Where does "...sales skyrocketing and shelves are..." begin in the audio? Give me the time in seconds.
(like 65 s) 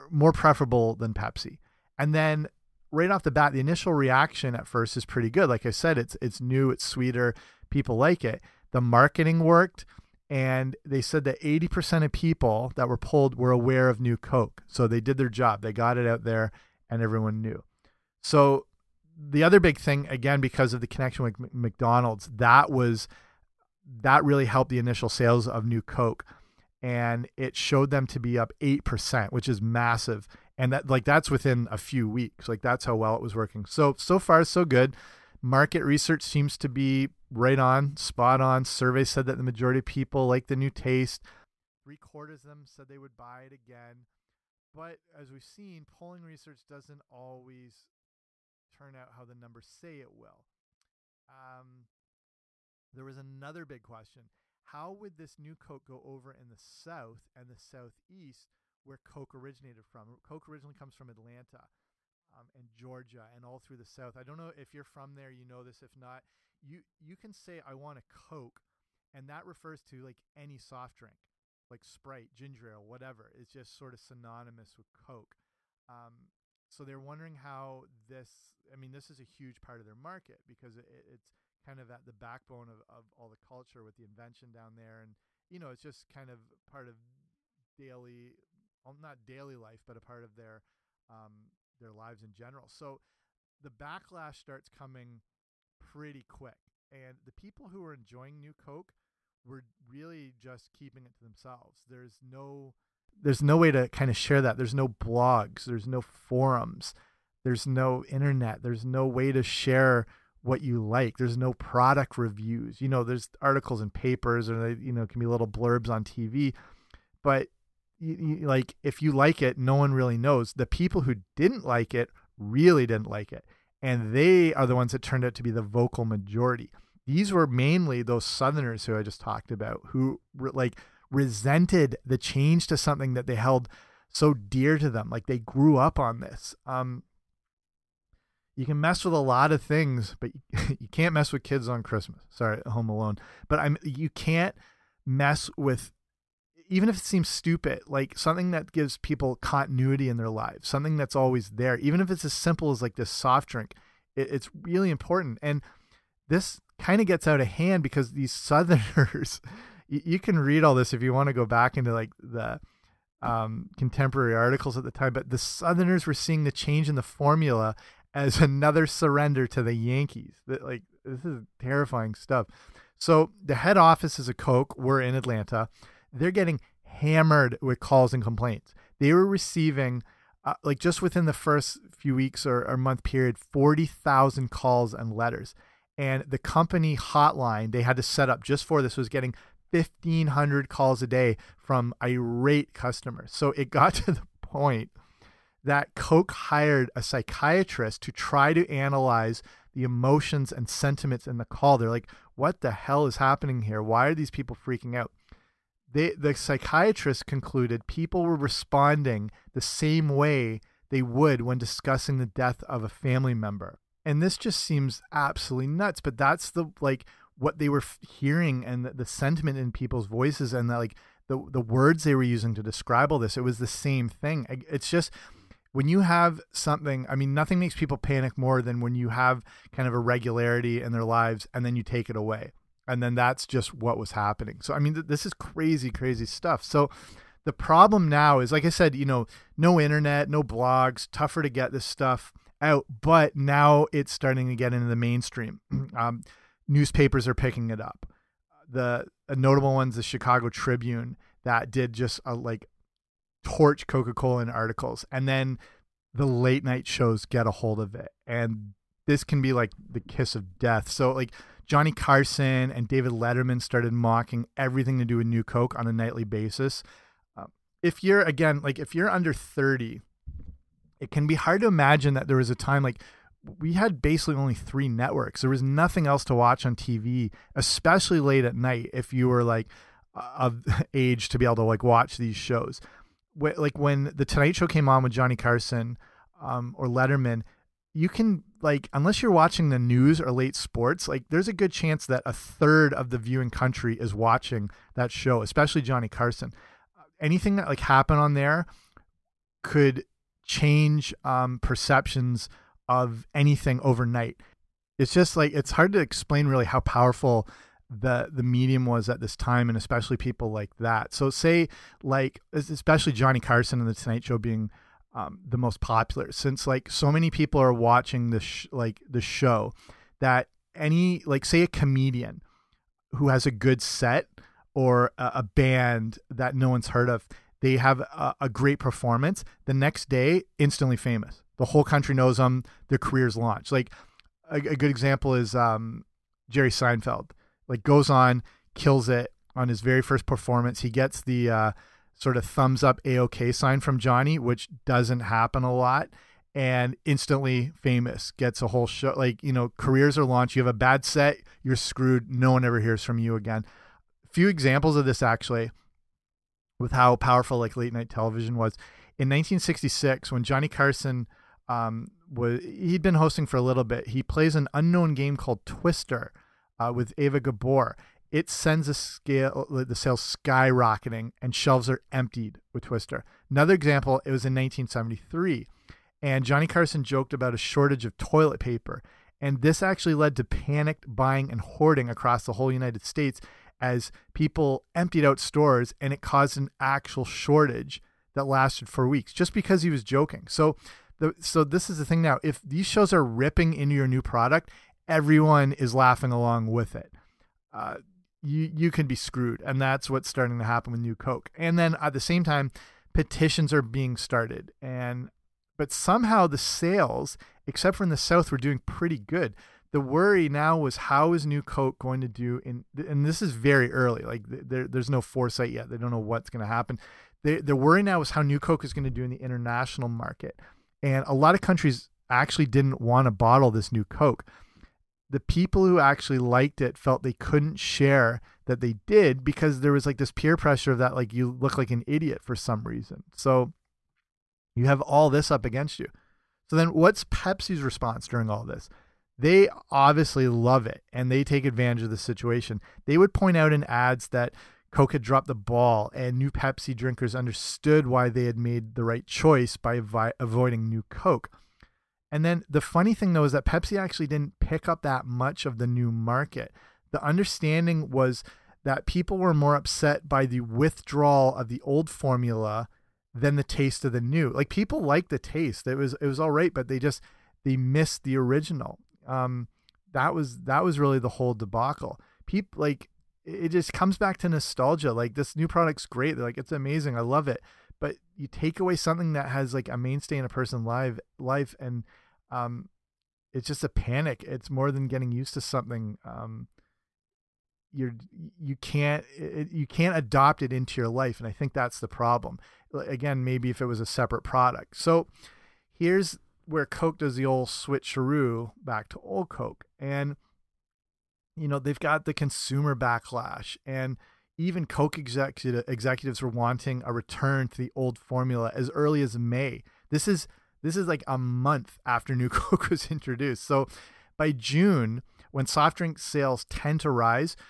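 369 s.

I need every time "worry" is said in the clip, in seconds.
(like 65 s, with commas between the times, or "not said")
410 s, 417 s.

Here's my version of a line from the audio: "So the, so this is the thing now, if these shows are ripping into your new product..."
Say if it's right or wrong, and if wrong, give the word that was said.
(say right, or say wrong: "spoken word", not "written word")
right.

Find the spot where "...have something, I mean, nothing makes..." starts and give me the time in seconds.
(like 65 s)
226 s.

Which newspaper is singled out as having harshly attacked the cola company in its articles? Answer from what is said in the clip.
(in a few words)
Chicago Tribune.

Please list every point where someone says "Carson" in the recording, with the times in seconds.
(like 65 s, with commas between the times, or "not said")
261 s, 285 s, 296 s, 313 s, 360 s, 376 s.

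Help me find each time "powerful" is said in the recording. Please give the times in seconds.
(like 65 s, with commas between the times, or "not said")
306 s, 357 s.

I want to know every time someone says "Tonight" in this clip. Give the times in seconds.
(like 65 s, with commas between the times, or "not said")
284 s, 313 s.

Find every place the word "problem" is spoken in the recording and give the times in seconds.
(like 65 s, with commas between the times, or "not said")
237 s, 492 s.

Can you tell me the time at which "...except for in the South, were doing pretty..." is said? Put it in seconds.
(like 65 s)
407 s.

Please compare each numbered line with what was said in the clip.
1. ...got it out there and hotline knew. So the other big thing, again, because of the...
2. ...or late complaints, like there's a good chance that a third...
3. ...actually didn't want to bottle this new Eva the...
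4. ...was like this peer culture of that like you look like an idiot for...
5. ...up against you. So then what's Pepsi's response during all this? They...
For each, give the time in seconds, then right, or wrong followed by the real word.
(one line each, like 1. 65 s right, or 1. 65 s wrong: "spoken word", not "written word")
1. 15 s wrong: "everyone", not "hotline"
2. 290 s wrong: "sports", not "complaints"
3. 422 s wrong: "Coke", not "Eva"
4. 429 s wrong: "pressure", not "culture"
5. 435 s right.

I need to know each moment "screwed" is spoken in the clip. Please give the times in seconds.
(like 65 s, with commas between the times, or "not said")
351 s, 399 s.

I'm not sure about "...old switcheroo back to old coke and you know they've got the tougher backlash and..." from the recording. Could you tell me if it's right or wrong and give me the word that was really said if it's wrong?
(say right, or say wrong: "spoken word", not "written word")
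wrong: "consumer", not "tougher".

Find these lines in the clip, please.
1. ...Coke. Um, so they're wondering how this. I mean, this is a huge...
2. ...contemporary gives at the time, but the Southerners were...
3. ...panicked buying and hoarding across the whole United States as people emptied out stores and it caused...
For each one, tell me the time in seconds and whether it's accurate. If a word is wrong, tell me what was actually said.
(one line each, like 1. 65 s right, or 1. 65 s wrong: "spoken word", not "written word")
1. 74 s right
2. 163 s wrong: "articles", not "gives"
3. 380 s right.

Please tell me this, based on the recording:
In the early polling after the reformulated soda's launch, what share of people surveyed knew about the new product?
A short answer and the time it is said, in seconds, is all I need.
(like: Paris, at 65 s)
80%, at 11 s.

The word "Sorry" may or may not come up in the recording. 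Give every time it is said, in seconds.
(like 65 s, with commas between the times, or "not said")
142 s.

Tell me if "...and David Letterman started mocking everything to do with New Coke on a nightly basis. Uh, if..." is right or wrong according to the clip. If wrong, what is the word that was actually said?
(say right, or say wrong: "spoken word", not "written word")
right.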